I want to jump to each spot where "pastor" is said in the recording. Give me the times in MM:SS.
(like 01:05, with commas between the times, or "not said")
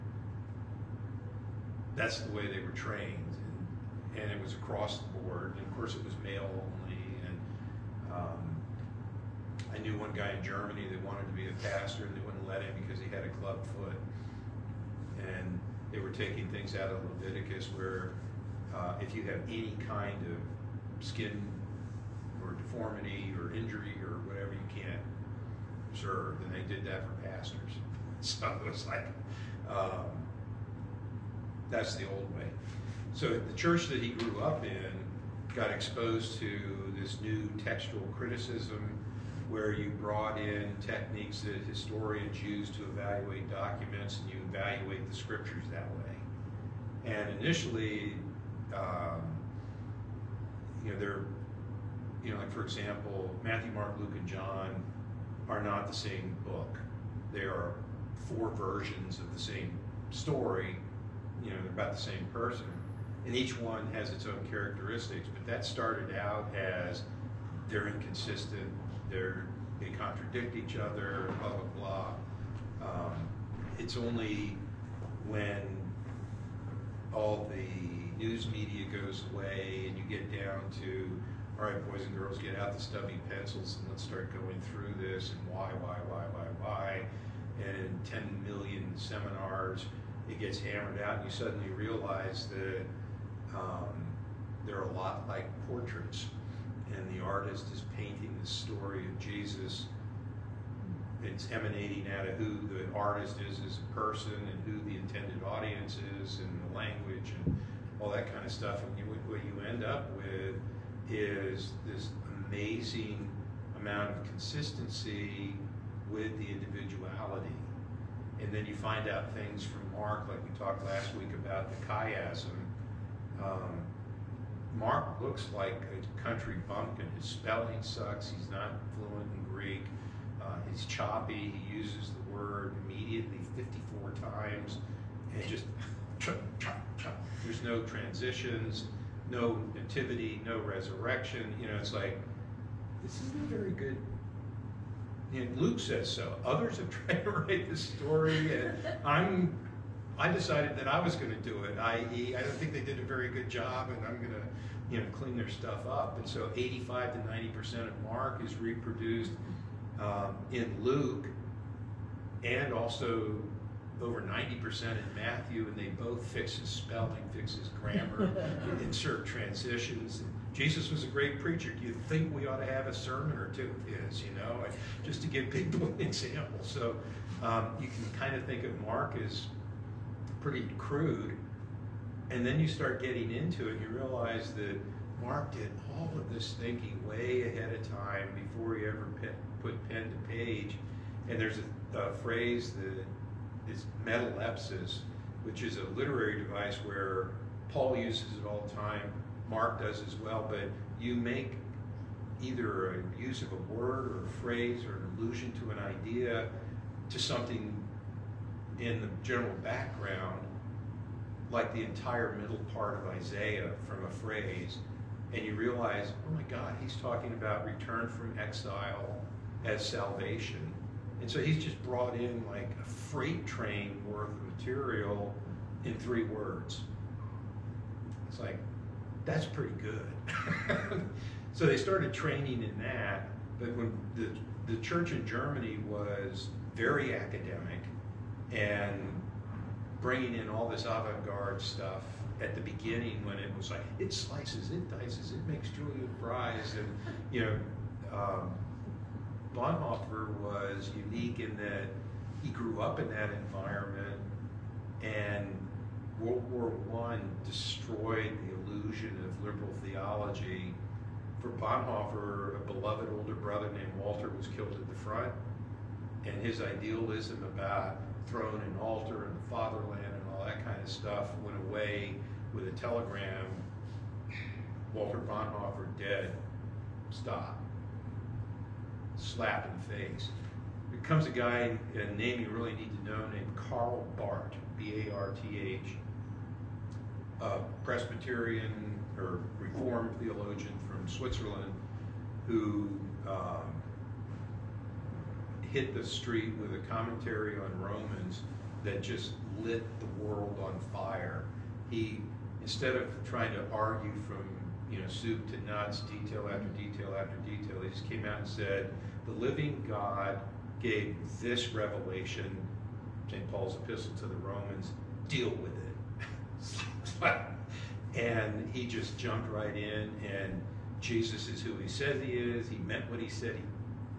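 00:11, 00:27.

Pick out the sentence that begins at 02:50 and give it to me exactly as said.
And, Jesus was a great preacher.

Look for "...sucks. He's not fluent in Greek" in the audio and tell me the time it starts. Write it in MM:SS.
02:07.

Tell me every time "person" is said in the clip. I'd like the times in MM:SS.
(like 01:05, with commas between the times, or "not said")
01:02, 01:43.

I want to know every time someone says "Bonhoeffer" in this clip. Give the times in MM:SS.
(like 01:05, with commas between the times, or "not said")
04:09, 04:21, 04:35.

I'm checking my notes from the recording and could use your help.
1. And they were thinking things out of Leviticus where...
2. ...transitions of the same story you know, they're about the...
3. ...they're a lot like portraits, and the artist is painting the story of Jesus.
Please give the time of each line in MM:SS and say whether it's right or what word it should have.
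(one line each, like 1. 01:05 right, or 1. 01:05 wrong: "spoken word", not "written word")
1. 00:15 wrong: "taking", not "thinking"
2. 00:58 wrong: "versions", not "transitions"
3. 01:34 right.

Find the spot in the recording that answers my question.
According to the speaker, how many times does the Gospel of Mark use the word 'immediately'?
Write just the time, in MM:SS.
02:13.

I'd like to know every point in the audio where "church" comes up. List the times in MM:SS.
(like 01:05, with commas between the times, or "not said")
00:33, 03:54.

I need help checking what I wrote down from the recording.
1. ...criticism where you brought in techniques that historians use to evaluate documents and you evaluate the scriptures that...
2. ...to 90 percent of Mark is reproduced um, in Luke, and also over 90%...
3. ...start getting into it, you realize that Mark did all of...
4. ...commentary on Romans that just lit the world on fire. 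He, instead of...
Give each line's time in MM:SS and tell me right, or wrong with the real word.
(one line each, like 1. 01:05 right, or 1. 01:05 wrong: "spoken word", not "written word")
1. 00:38 right
2. 02:37 right
3. 03:02 right
4. 04:56 right.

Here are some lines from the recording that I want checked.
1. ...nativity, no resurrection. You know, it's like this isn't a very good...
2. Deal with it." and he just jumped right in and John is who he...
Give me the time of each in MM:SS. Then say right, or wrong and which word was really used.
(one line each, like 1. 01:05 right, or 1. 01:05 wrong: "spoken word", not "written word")
1. 02:19 right
2. 05:15 wrong: "Jesus", not "John".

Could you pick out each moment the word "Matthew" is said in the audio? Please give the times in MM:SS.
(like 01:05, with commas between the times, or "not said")
00:53, 02:45.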